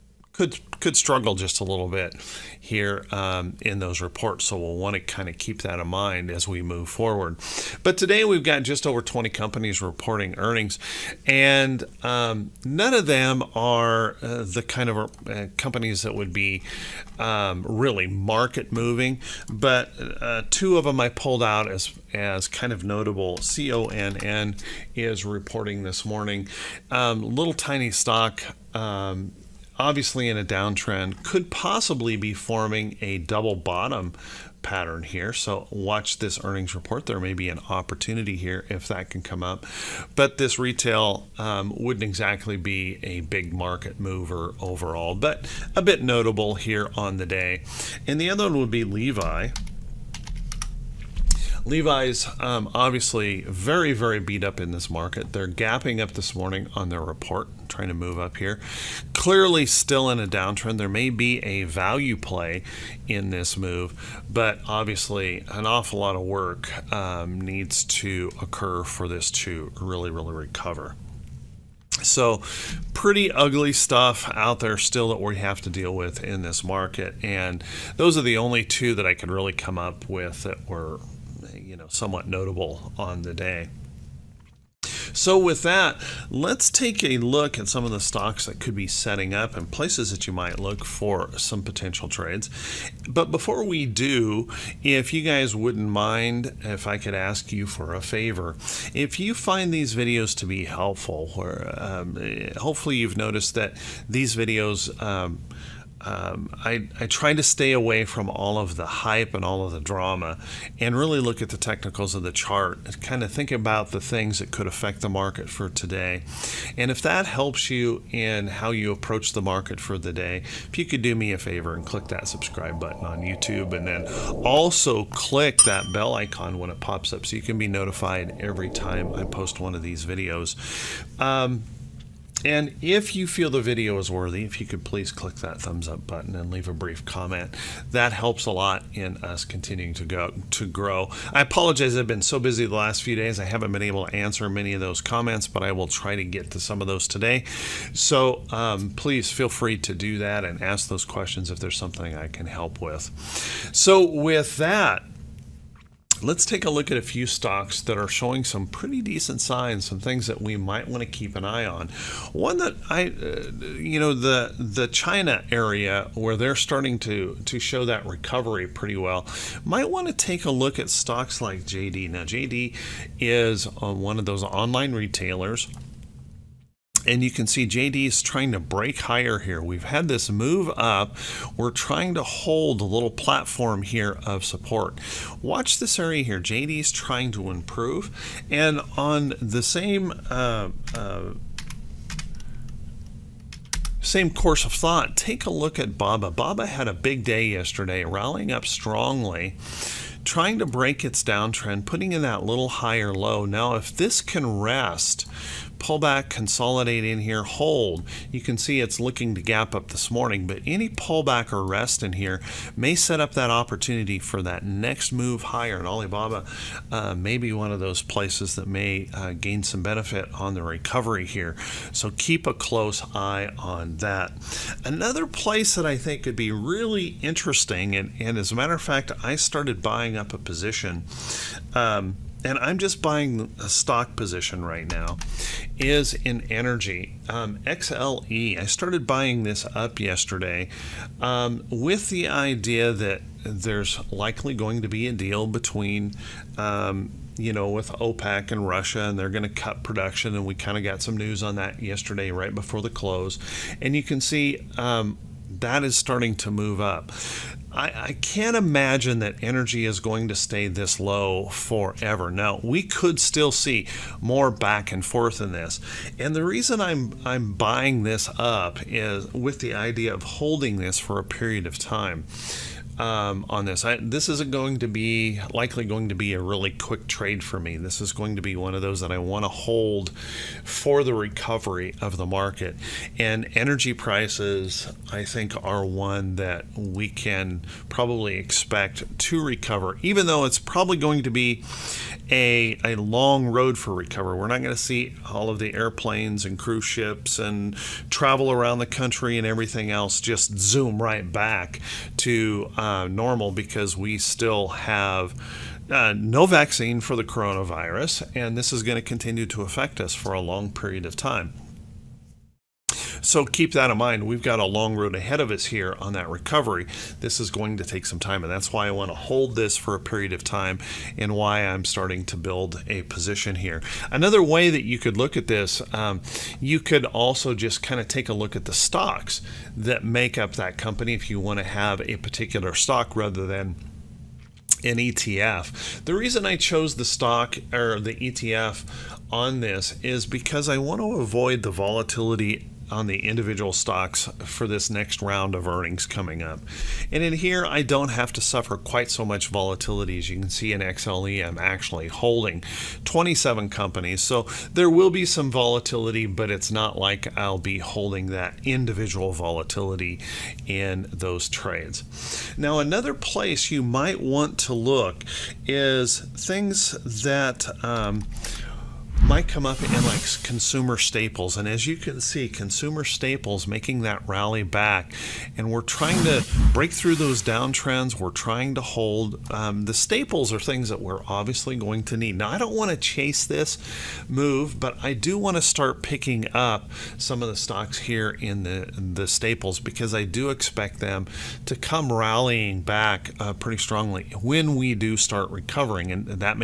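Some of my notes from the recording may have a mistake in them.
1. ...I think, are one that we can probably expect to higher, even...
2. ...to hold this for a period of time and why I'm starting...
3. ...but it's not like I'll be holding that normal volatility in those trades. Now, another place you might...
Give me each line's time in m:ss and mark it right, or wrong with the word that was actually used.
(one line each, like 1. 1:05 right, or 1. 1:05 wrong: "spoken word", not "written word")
1. 4:45 wrong: "recover", not "higher"
2. 5:19 right
3. 5:56 wrong: "individual", not "normal".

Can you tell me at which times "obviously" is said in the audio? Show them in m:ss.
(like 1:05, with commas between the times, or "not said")
0:29, 0:52, 1:04, 6:21.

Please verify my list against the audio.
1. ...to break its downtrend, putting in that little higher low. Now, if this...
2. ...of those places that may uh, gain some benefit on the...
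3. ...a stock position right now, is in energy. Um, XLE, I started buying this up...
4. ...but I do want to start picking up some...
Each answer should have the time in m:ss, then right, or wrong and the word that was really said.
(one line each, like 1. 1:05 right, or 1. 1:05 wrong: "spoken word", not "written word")
1. 3:20 right
2. 3:37 right
3. 3:53 right
4. 6:24 right.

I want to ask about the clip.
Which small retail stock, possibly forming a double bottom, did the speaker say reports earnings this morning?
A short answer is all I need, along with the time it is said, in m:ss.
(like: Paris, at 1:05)
CONN, at 0:23.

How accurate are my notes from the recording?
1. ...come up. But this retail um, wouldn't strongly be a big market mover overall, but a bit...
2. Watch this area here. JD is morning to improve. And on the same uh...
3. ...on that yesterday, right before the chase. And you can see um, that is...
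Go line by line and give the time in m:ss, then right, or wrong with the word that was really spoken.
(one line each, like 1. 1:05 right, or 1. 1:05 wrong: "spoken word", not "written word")
1. 0:39 wrong: "exactly", not "strongly"
2. 3:05 wrong: "trying", not "morning"
3. 4:11 wrong: "close", not "chase".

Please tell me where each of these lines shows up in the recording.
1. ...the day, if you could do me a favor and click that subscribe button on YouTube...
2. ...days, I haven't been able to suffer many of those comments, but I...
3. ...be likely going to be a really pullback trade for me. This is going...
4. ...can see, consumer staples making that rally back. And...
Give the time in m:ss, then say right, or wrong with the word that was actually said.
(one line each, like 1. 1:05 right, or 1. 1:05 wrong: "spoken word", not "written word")
1. 1:59 right
2. 2:23 wrong: "answer", not "suffer"
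3. 4:34 wrong: "quick", not "pullback"
4. 6:11 right.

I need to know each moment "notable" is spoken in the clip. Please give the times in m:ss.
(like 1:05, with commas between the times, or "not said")
0:22, 0:46, 1:22.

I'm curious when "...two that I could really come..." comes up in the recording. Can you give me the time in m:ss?
1:18.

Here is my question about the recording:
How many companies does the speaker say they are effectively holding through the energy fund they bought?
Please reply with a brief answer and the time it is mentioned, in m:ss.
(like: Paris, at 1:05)
27, at 5:53.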